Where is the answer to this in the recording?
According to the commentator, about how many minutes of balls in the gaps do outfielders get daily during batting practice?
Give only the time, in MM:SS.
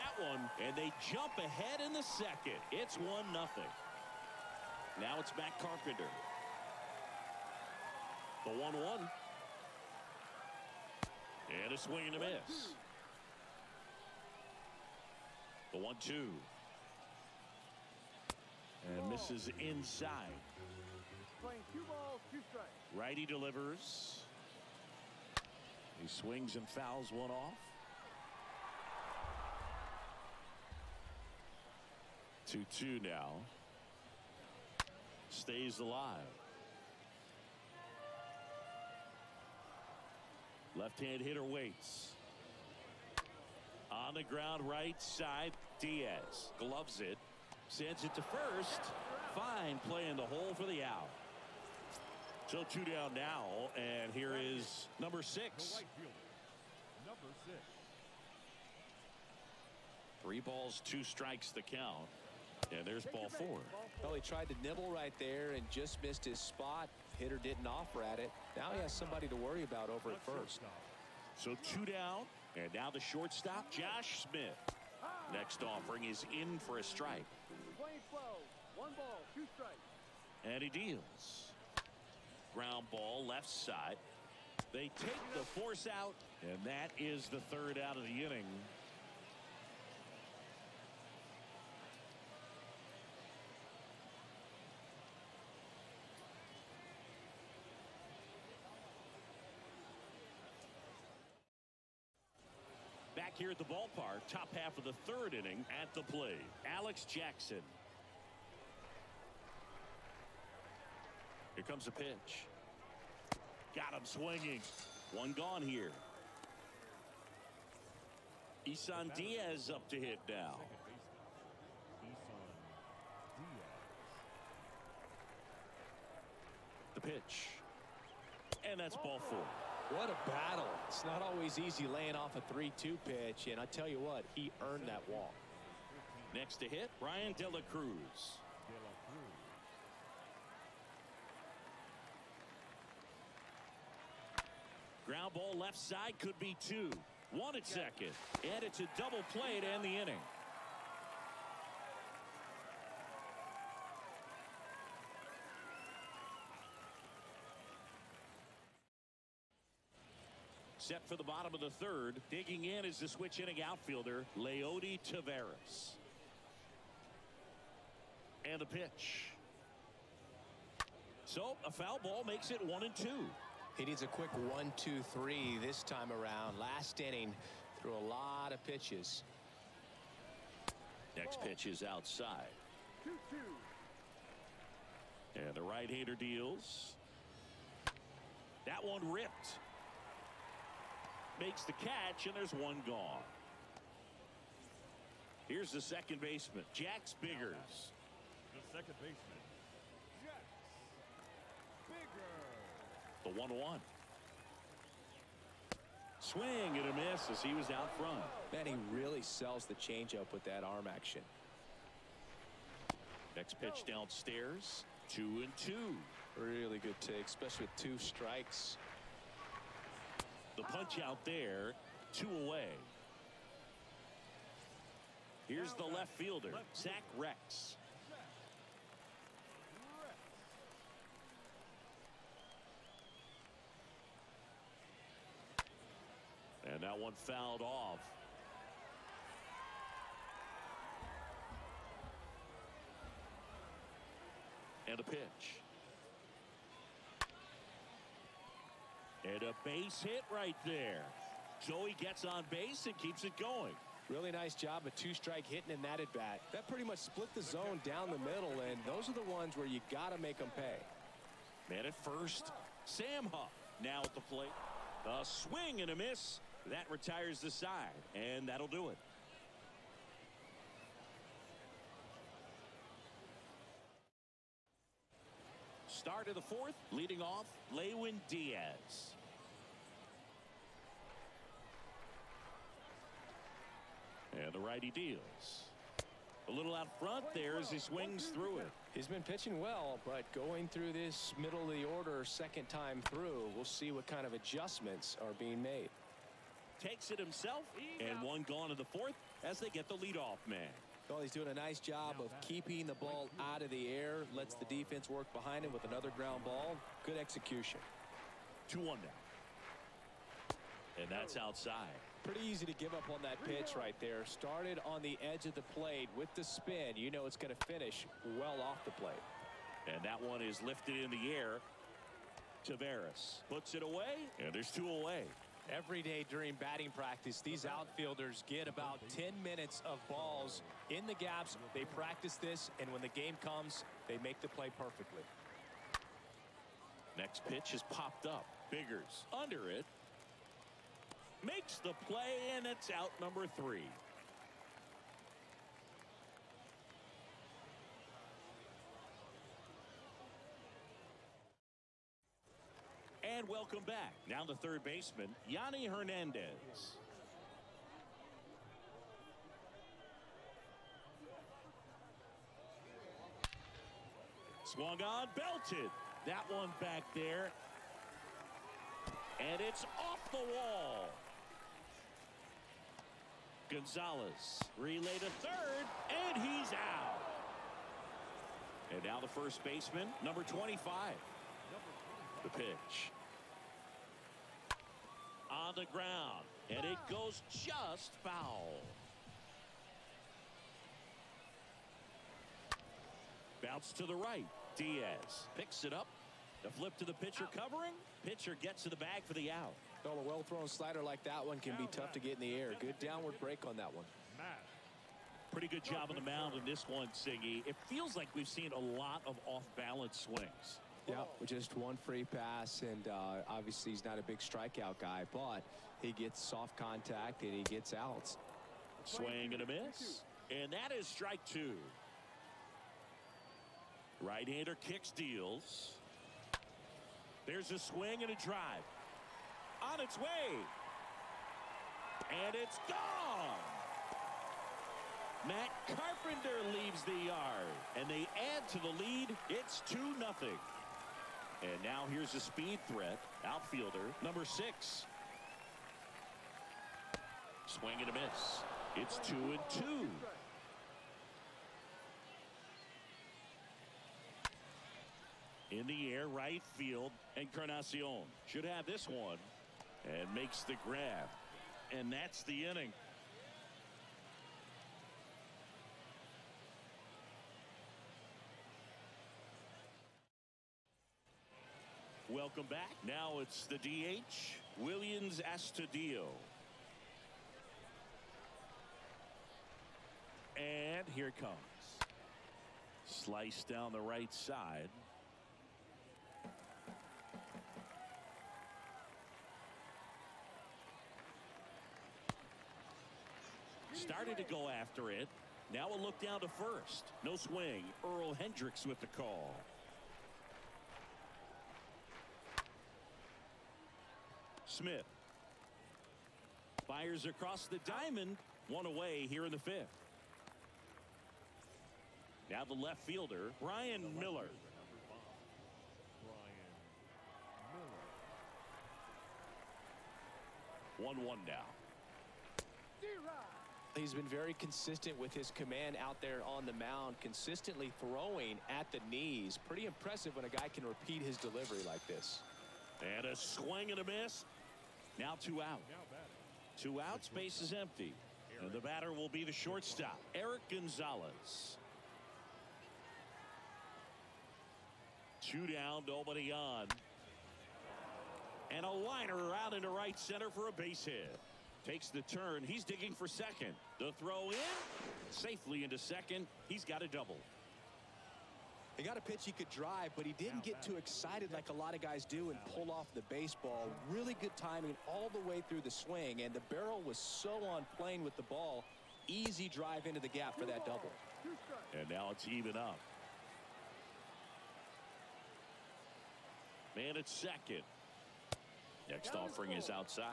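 05:29.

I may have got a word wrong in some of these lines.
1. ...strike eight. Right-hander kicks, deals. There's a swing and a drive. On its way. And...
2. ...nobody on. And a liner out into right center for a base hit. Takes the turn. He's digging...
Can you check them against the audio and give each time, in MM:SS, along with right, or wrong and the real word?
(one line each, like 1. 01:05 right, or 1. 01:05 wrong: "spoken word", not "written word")
1. 07:01 wrong: "two", not "eight"
2. 09:06 right.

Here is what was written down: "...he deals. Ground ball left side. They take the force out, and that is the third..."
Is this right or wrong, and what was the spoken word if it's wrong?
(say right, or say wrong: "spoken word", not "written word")
right.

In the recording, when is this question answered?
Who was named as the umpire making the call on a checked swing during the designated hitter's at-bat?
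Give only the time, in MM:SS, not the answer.
08:18.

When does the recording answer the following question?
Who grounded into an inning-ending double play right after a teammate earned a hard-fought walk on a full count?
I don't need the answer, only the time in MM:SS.
02:16.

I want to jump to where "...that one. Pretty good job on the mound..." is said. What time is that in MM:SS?
06:43.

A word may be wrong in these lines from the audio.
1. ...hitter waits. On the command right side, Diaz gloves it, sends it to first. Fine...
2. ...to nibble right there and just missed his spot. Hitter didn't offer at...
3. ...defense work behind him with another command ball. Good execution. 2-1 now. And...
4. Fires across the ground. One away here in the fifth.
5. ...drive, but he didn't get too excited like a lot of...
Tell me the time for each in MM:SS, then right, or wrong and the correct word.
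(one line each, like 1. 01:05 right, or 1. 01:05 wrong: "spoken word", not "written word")
1. 00:41 wrong: "ground", not "command"
2. 01:04 right
3. 05:04 wrong: "ground", not "command"
4. 08:26 wrong: "diamond", not "ground"
5. 09:19 right.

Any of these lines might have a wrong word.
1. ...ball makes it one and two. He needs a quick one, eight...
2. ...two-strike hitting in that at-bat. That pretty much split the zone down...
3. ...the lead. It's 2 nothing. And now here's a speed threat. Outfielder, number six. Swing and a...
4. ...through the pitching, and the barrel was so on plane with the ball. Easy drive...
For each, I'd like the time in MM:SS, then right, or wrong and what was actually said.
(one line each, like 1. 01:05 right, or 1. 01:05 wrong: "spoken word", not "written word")
1. 02:52 wrong: "two", not "eight"
2. 04:14 right
3. 07:18 right
4. 09:25 wrong: "swing", not "pitching".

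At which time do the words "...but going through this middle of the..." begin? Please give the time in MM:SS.
04:50.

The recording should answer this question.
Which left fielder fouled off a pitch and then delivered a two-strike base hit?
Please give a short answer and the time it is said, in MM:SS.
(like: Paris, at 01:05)
Zach Reks, at 03:46.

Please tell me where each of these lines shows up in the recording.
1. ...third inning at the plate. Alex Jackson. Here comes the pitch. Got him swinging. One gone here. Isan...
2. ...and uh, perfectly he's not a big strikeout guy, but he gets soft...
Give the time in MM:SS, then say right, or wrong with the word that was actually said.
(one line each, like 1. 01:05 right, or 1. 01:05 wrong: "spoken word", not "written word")
1. 01:45 right
2. 06:52 wrong: "obviously", not "perfectly".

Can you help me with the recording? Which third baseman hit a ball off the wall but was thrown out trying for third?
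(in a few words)
Yonny Hernandez.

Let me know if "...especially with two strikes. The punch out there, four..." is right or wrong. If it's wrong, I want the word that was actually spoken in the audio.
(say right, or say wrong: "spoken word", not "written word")
wrong: "two", not "four".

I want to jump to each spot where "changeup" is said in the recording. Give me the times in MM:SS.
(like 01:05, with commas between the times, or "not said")
03:29.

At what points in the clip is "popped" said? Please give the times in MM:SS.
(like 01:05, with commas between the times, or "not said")
05:37.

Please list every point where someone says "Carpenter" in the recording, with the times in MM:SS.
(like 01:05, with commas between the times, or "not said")
00:05, 07:15.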